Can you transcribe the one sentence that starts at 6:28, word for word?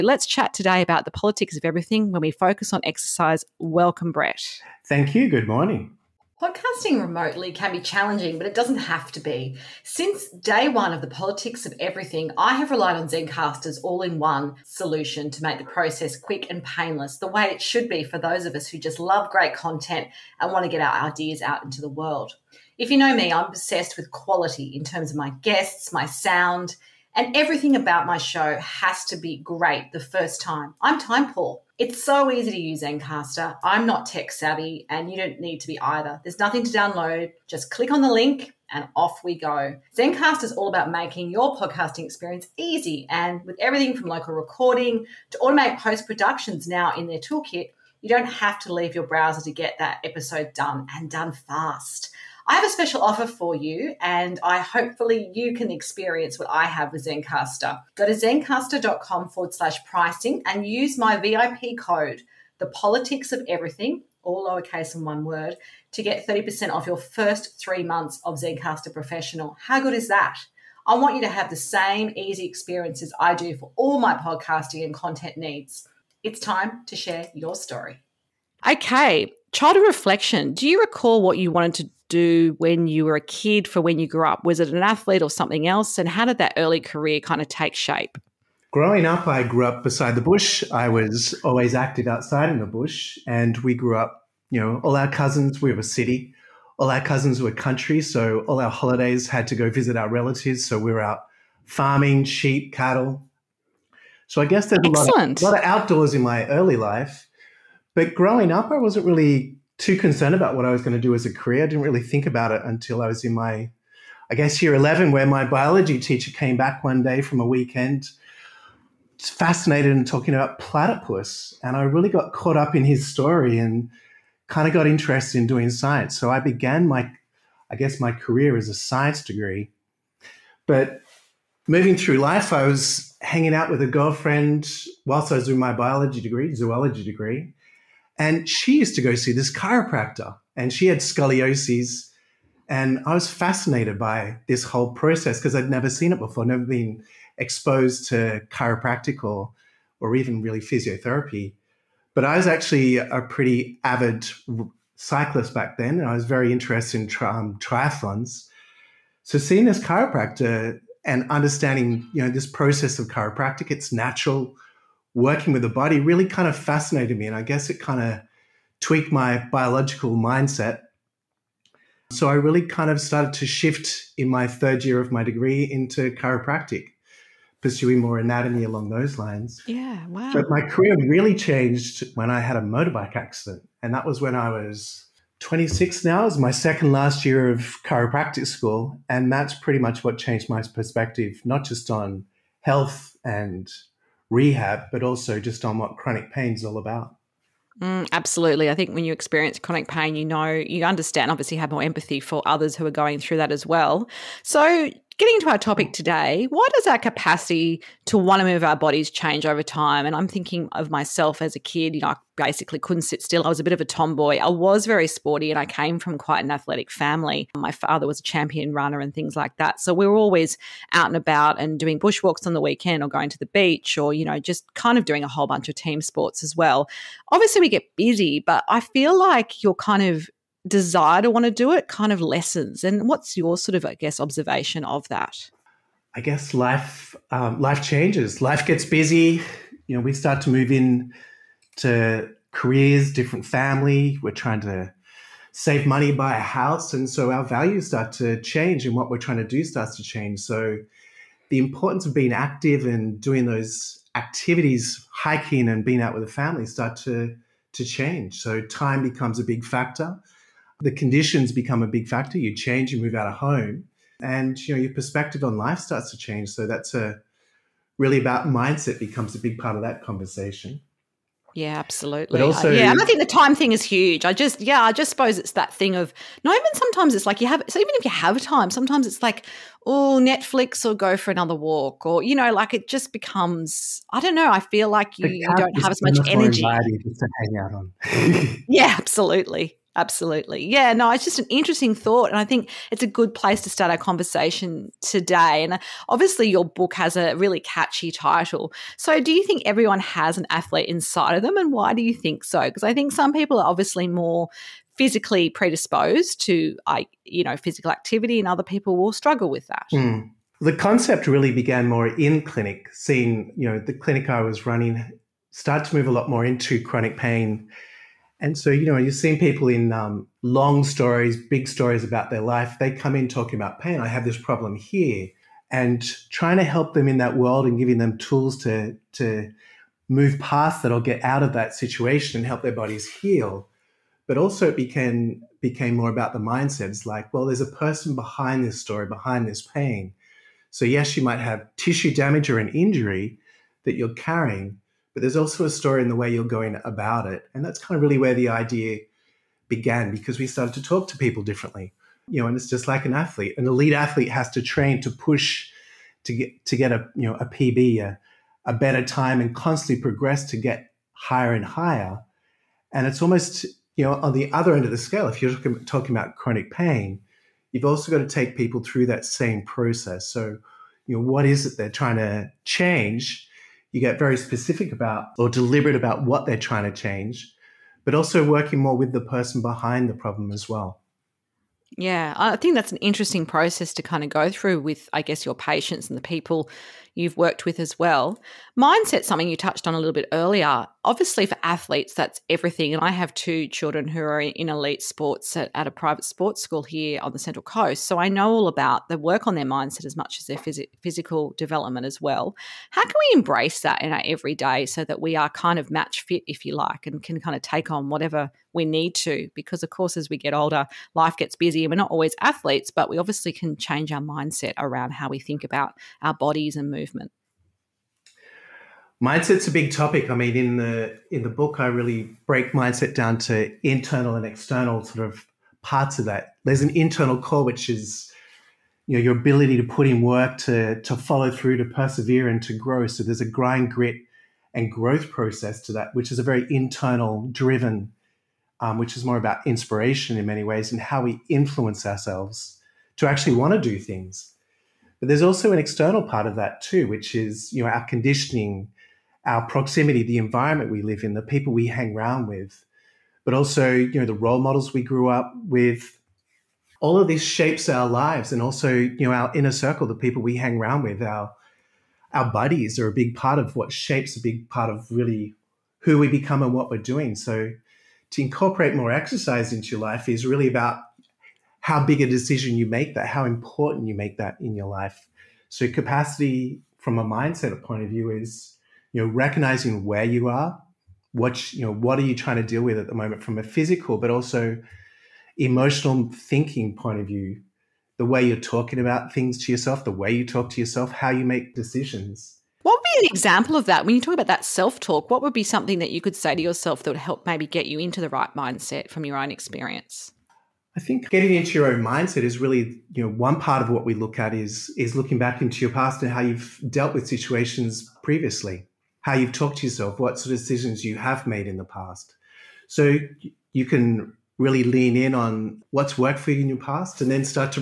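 Mindset, something you touched on a little bit earlier.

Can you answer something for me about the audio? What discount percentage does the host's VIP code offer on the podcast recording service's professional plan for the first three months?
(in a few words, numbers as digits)
30%.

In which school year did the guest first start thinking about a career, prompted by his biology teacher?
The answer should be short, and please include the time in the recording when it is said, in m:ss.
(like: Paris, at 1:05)
Year 11, at 1:54.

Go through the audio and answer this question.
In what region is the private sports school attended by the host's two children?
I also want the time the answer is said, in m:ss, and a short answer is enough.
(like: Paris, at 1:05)
Central Coast, at 6:37.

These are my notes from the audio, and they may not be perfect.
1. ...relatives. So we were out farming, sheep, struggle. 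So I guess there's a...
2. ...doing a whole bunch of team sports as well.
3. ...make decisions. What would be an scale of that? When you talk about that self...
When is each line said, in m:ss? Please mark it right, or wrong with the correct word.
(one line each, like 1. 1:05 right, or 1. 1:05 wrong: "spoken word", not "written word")
1. 1:40 wrong: "cattle", not "struggle"
2. 3:45 right
3. 8:11 wrong: "example", not "scale".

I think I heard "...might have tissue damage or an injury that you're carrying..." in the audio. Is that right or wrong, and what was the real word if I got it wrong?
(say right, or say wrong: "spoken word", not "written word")
right.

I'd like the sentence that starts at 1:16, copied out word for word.
It's time to share your story.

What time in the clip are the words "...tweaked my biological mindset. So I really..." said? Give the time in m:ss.
2:48.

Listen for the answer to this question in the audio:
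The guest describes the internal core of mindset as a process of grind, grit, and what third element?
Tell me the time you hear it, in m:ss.
7:14.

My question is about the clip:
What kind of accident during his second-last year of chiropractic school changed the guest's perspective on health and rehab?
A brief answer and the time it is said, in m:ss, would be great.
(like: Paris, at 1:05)
Motorbike accident, at 3:02.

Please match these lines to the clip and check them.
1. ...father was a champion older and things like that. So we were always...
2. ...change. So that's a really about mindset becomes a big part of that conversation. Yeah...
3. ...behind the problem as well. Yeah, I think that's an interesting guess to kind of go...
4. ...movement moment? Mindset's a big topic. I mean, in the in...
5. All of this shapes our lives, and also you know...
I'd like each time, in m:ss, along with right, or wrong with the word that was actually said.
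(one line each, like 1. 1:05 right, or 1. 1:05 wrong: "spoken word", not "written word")
1. 3:37 wrong: "runner", not "older"
2. 4:26 right
3. 6:19 wrong: "process", not "guess"
4. 6:56 wrong: "movement", not "moment"
5. 7:37 right.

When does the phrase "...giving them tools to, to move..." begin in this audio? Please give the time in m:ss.
5:27.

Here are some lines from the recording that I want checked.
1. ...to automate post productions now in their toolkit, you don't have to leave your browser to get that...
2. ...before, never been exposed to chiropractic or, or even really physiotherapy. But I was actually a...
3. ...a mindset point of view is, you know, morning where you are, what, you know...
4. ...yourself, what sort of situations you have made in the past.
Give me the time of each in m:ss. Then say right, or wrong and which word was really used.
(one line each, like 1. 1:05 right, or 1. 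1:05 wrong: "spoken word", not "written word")
1. 0:45 right
2. 2:26 right
3. 7:57 wrong: "recognizing", not "morning"
4. 8:29 wrong: "decisions", not "situations".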